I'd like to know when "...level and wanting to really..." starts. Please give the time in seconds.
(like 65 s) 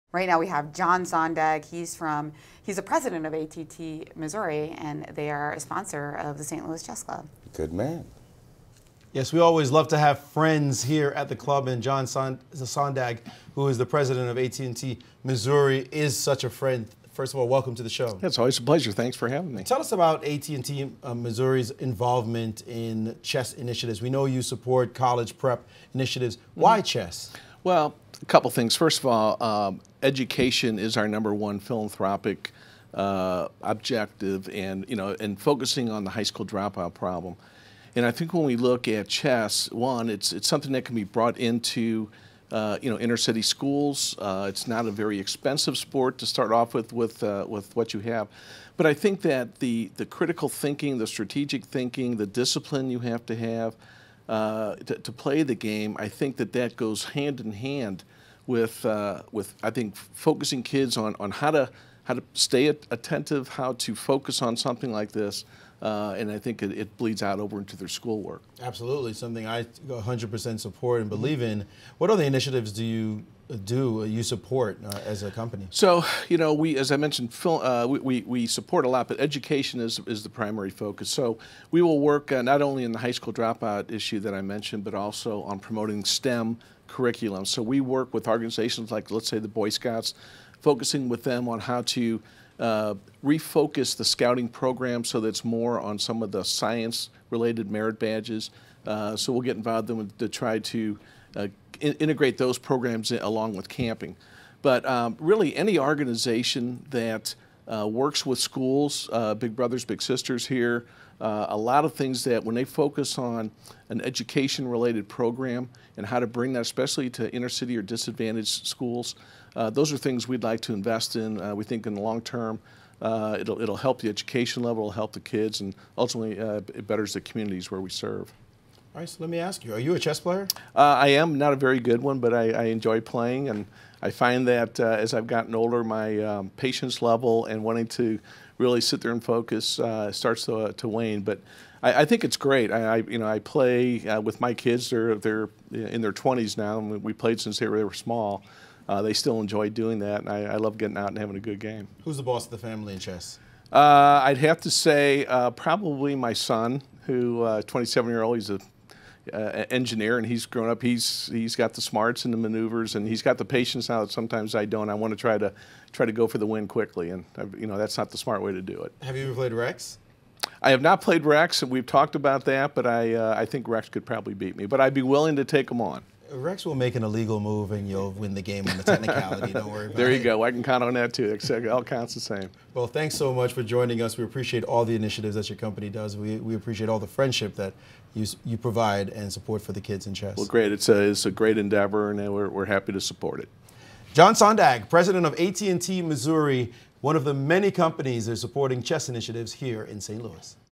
137 s.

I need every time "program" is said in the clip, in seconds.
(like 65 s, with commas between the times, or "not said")
94 s, 102 s, 115 s.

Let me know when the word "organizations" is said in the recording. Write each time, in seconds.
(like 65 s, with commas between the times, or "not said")
88 s, 105 s.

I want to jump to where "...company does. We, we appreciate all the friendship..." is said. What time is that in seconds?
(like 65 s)
185 s.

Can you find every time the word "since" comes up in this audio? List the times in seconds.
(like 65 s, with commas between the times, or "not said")
147 s.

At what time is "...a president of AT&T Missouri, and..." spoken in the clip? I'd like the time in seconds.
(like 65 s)
2 s.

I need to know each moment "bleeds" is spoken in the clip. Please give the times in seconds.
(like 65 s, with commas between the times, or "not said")
66 s.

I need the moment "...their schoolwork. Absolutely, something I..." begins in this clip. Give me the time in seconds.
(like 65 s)
67 s.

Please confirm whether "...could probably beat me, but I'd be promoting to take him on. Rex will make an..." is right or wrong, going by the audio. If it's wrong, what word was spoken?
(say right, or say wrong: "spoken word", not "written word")
wrong: "willing", not "promoting".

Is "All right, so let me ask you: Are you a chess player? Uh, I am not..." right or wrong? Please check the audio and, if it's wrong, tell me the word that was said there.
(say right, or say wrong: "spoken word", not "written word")
right.